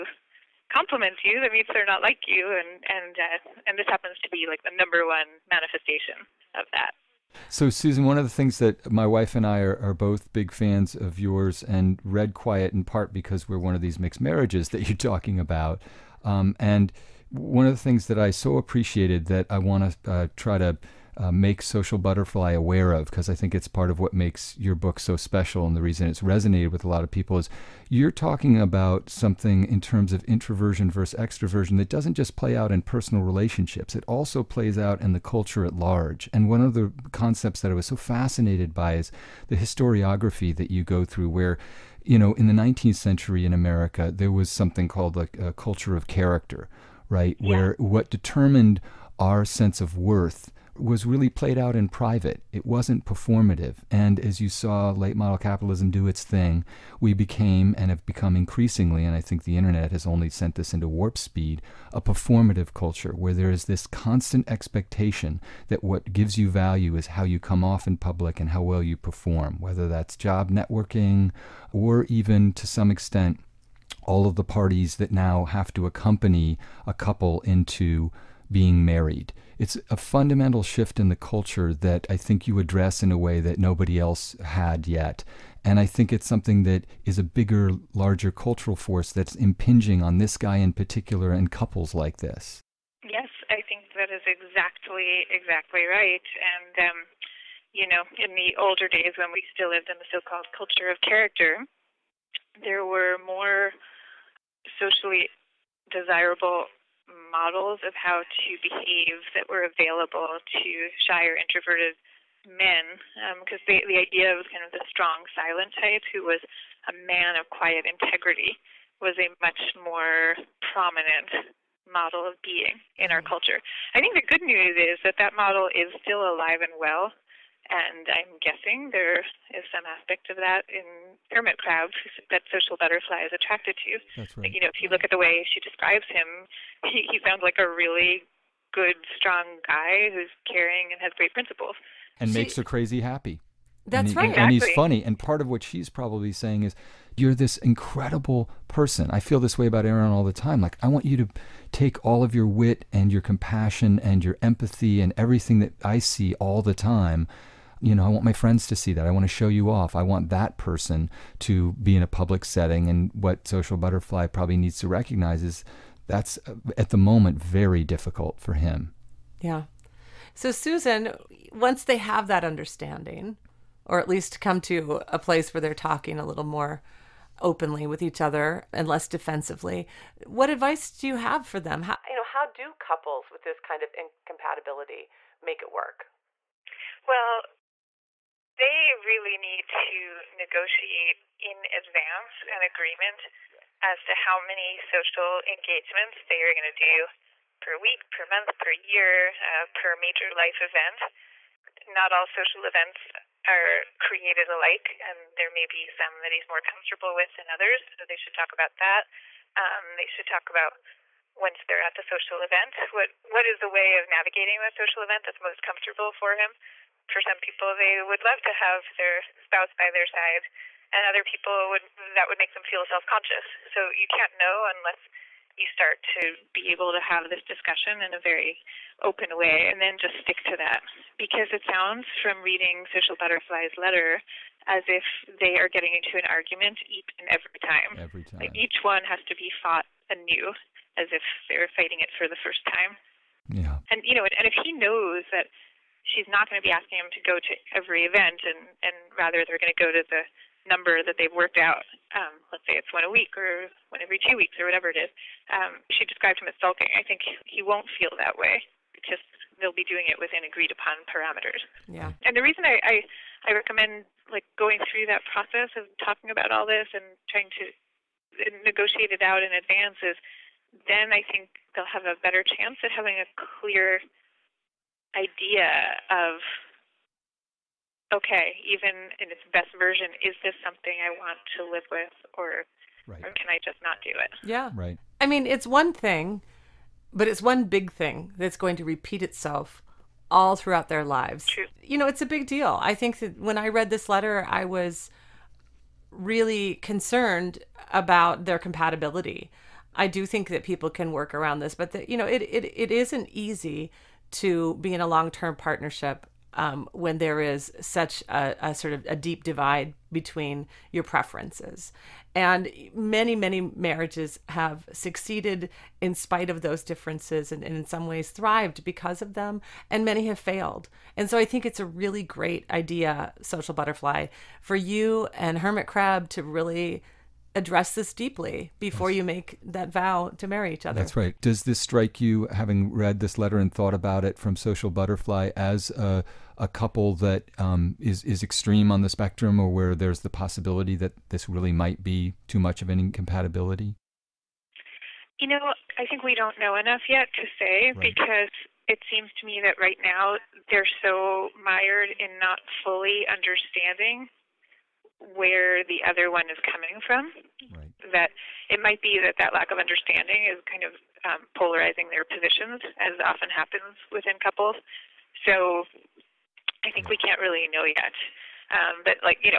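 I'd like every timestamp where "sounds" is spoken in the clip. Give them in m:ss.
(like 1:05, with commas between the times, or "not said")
2:17, 3:51.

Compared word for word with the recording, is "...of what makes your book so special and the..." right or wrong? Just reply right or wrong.
right.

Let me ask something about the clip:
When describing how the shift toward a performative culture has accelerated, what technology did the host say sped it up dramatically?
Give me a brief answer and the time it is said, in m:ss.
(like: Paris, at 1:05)
the internet, at 0:59.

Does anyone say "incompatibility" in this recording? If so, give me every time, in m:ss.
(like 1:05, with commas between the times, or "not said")
3:03, 5:42.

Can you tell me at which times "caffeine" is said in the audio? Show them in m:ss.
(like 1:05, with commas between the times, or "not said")
not said.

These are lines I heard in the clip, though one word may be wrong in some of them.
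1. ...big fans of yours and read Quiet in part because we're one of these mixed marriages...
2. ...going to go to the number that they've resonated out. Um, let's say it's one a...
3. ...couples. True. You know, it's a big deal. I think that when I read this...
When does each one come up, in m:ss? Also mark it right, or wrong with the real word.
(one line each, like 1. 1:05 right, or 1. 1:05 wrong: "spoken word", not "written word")
1. 0:10 right
2. 4:09 wrong: "worked", not "resonated"
3. 4:51 wrong: "lives", not "couples".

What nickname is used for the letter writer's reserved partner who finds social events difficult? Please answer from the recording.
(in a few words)
Hermit Crab.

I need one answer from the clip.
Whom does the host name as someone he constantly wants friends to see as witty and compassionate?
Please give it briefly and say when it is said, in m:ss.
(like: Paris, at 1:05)
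Erin, at 2:29.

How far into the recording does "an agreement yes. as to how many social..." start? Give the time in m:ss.
3:12.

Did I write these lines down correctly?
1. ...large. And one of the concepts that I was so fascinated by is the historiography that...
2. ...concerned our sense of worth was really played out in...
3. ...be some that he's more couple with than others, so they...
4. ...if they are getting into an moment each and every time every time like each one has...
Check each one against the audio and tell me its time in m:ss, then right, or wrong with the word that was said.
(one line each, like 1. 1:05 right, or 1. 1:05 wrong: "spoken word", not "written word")
1. 0:35 right
2. 0:48 wrong: "determined", not "concerned"
3. 3:25 wrong: "comfortable", not "couple"
4. 3:54 wrong: "argument", not "moment".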